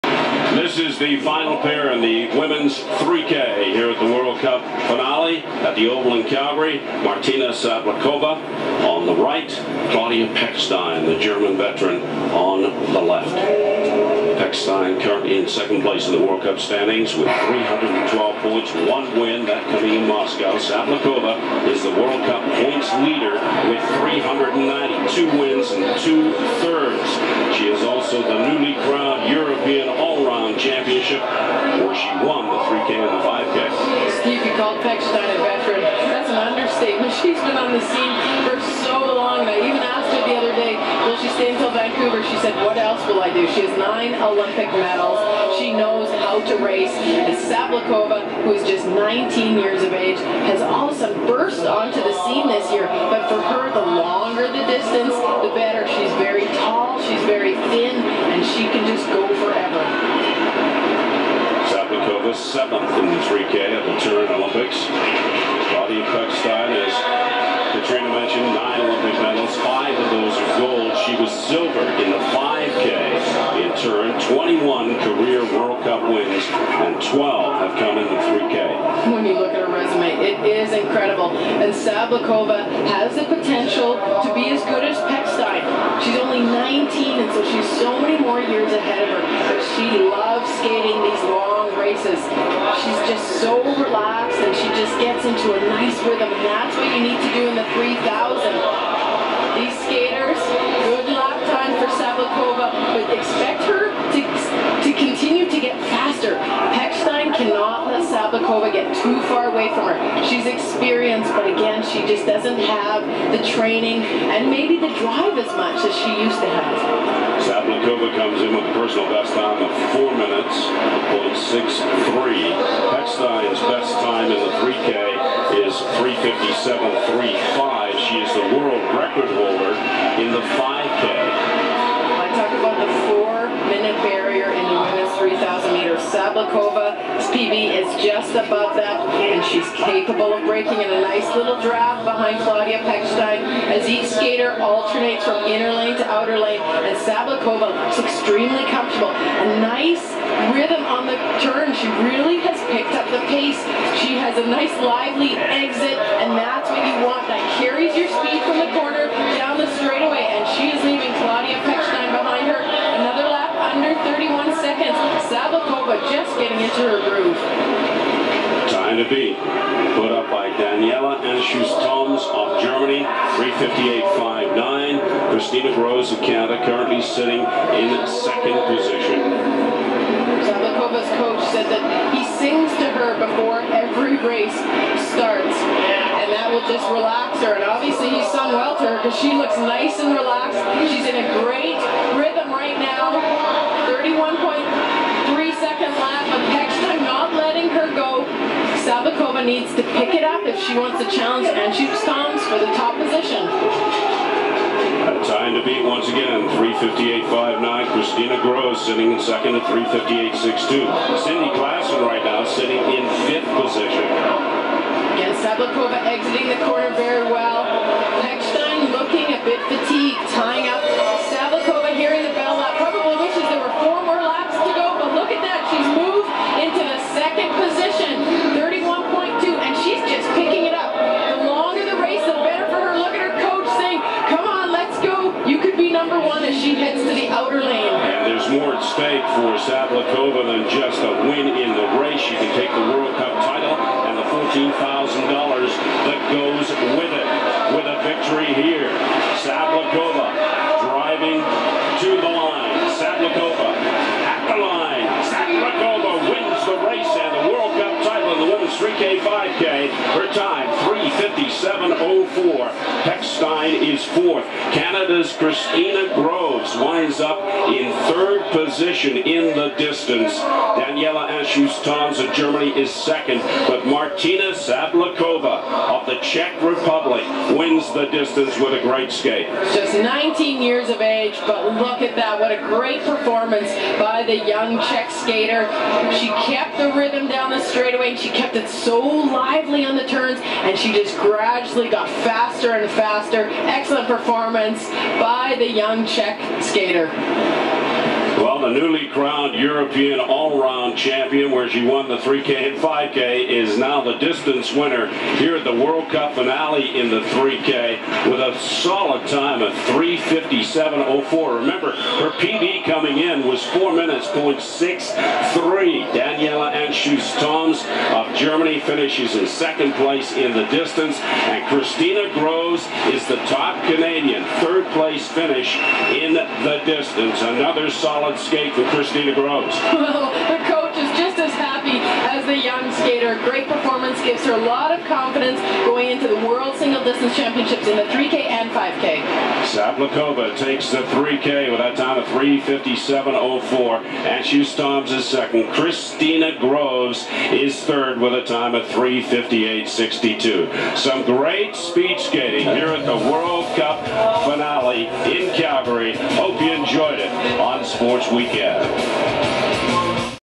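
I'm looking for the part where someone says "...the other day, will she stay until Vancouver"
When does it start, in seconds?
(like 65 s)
40 s.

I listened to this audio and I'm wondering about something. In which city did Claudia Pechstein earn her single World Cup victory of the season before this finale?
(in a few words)
Moscow.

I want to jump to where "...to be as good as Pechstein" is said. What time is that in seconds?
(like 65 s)
84 s.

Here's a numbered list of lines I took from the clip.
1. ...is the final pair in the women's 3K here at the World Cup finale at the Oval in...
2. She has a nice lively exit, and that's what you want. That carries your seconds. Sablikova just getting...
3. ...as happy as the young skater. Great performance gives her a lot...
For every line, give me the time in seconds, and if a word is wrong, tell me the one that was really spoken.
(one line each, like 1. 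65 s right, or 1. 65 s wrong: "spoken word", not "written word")
1. 0 s right
2. 154 s right
3. 331 s right.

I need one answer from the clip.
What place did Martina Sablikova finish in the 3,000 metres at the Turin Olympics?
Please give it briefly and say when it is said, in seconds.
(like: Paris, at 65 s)
Seventh, at 62 s.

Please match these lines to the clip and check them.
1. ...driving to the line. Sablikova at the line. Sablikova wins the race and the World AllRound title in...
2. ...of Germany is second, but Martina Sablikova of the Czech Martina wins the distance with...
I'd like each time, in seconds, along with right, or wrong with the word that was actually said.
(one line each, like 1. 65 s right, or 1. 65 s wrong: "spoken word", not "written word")
1. 250 s wrong: "Cup", not "AllRound"
2. 272 s wrong: "Republic", not "Martina".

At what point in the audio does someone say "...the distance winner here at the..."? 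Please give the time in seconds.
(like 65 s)
304 s.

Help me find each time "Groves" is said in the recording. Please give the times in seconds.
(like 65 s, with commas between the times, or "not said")
175 s, 208 s, 266 s, 322 s, 329 s, 346 s.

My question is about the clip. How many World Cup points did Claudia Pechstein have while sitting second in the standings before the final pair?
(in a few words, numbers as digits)
312.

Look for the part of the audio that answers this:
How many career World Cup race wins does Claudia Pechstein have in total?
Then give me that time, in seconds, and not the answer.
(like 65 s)
74 s.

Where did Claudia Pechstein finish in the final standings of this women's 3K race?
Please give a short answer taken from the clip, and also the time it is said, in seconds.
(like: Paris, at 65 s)
Fourth, at 264 s.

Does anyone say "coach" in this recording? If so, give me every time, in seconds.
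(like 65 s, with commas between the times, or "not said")
181 s, 330 s.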